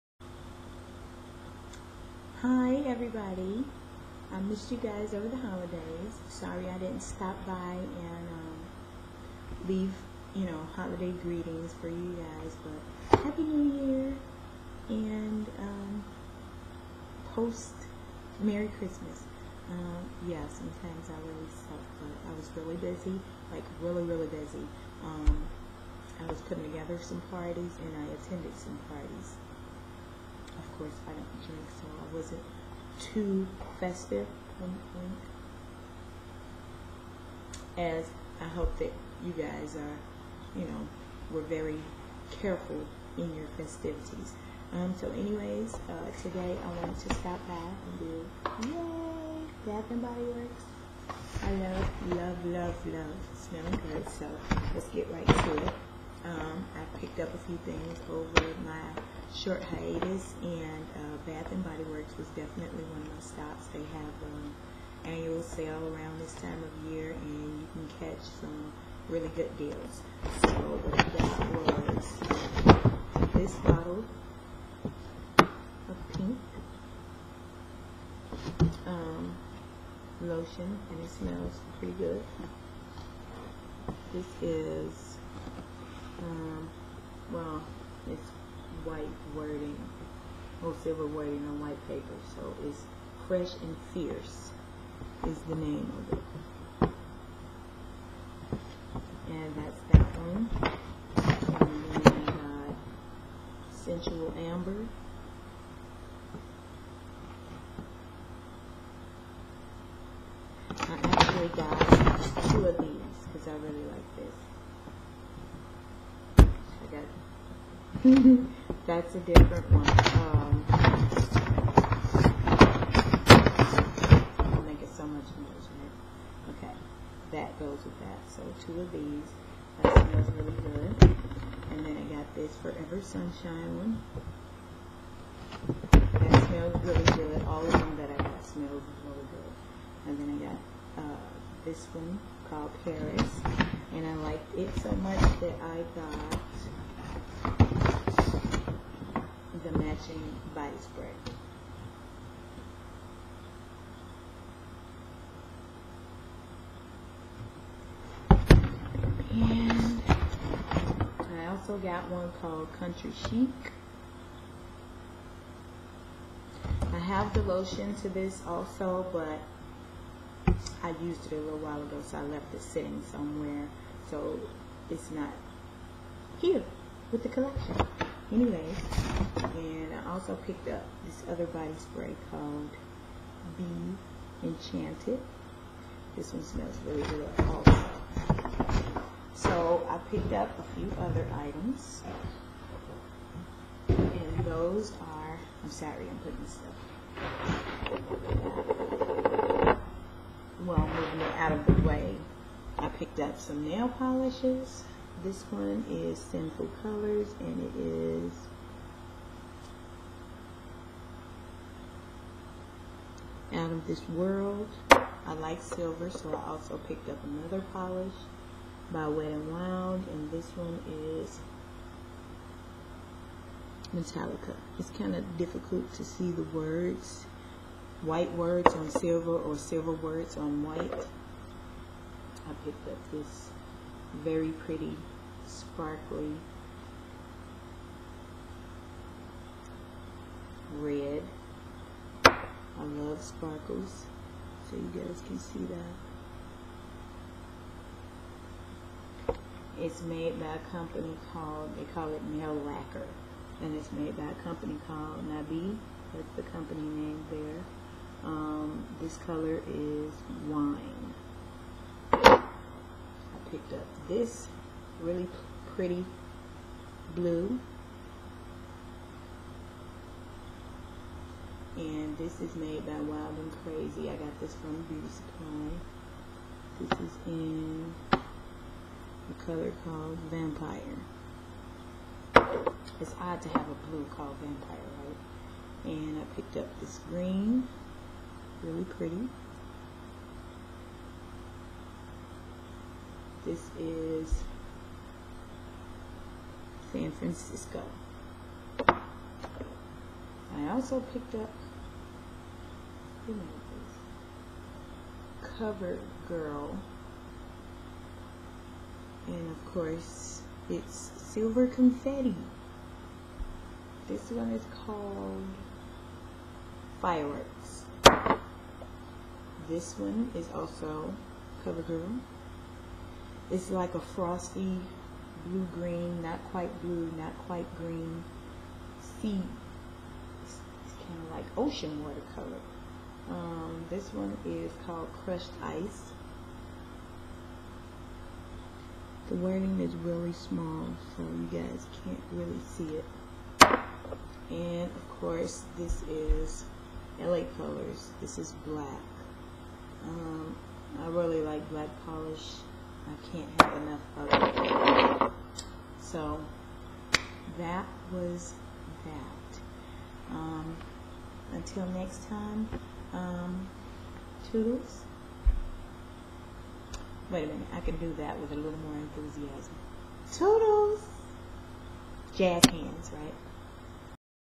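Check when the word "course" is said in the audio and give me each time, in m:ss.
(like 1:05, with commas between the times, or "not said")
0:30, 5:09, 5:45.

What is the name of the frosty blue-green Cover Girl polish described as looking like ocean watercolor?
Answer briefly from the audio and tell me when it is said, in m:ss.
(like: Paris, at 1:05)
Crushed Ice, at 5:35.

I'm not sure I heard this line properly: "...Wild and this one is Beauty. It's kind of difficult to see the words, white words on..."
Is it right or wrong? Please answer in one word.
wrong.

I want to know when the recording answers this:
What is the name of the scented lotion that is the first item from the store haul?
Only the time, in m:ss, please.
1:33.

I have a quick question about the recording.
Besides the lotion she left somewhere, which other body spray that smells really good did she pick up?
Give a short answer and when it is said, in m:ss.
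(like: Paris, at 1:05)
Be Enchanted, at 3:03.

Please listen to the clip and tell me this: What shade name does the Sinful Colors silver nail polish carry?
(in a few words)
Out of This World.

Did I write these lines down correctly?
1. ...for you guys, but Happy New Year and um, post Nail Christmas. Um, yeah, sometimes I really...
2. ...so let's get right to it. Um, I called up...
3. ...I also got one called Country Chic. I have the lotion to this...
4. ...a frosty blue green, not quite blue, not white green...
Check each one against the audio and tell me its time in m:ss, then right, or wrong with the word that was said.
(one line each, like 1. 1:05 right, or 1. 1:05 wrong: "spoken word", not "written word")
1. 0:11 wrong: "Merry", not "Nail"
2. 0:54 wrong: "picked", not "called"
3. 2:41 right
4. 5:23 wrong: "quite", not "white".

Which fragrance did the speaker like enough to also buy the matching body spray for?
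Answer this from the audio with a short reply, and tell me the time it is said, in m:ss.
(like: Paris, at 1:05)
Paris, at 2:22.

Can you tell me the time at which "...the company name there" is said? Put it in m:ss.
4:16.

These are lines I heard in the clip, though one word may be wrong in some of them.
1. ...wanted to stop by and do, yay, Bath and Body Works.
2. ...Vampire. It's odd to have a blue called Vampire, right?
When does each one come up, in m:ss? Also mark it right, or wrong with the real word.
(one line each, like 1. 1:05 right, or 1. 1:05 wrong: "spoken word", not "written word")
1. 0:46 right
2. 4:40 right.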